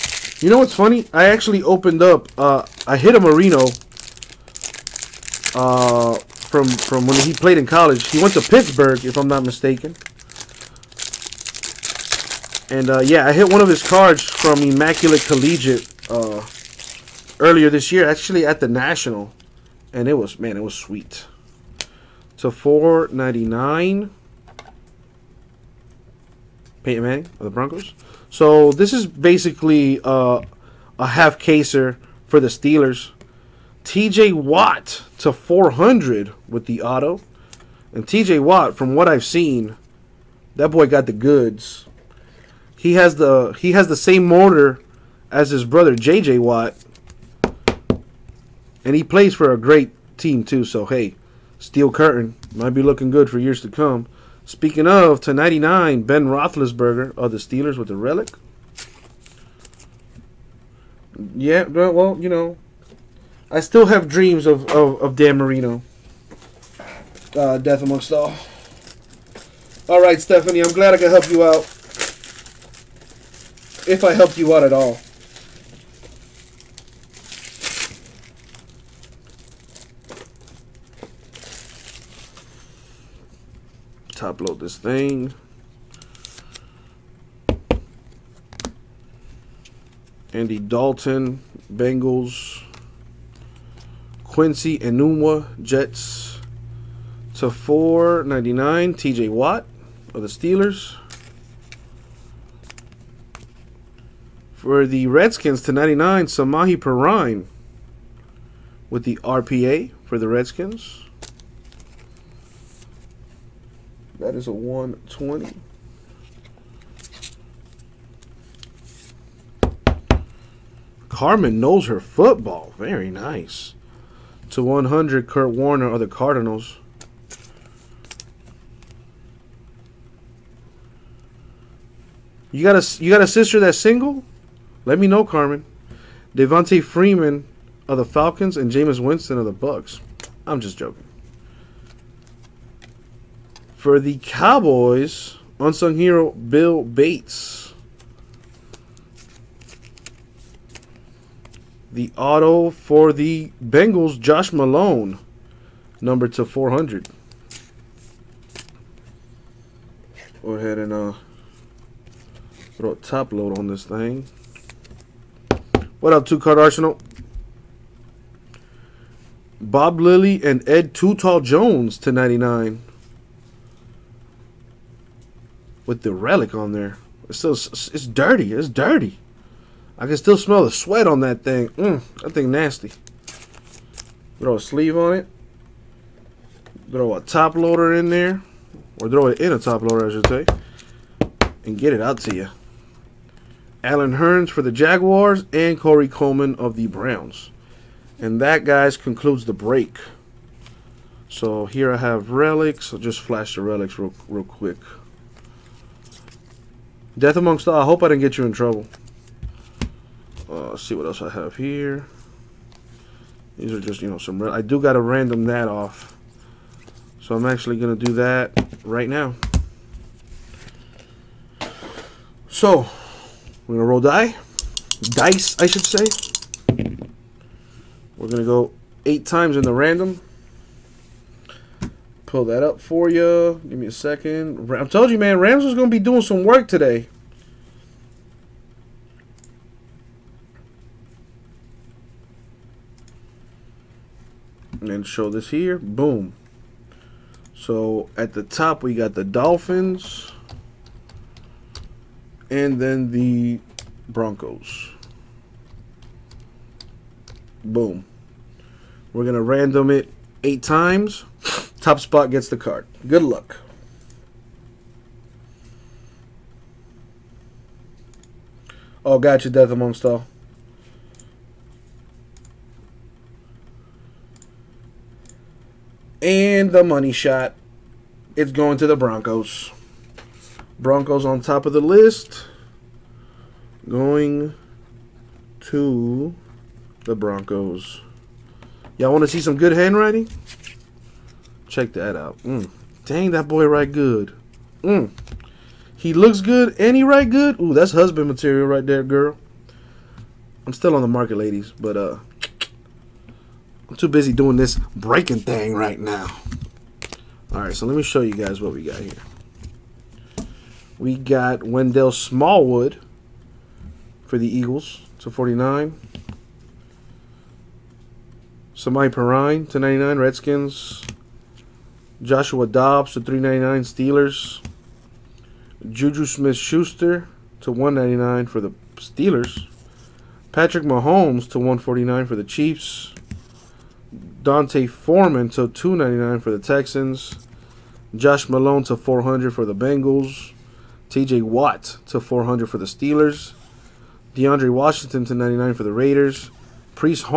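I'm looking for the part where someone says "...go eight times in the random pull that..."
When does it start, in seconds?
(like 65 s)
228 s.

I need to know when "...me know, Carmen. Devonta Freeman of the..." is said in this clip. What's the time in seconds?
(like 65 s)
134 s.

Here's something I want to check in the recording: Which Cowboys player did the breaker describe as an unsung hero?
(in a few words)
Bill Bates.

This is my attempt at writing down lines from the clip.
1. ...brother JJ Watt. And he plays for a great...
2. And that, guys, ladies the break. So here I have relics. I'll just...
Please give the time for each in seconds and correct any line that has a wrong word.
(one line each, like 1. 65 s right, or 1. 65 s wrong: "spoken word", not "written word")
1. 45 s right
2. 198 s wrong: "concludes", not "ladies".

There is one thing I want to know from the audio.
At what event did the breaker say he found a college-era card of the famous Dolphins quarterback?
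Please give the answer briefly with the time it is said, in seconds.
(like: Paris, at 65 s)
the National, at 18 s.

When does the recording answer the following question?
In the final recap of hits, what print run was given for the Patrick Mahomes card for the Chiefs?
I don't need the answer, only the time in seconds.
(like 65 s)
331 s.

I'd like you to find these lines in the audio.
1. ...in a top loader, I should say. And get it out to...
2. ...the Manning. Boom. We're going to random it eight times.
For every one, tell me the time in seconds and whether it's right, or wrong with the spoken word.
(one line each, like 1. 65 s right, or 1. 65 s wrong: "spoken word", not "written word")
1. 189 s right
2. 253 s wrong: "Broncos", not "Manning".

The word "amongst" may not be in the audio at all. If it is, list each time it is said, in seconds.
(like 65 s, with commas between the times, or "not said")
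67 s, 207 s, 269 s.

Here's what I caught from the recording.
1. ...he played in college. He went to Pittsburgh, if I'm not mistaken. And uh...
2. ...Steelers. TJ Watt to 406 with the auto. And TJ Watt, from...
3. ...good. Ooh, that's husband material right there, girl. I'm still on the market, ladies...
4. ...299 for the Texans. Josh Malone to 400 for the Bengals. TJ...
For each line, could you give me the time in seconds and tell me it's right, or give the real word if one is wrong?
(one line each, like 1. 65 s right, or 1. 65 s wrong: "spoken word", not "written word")
1. 7 s right
2. 32 s wrong: "400", not "406"
3. 297 s right
4. 335 s right.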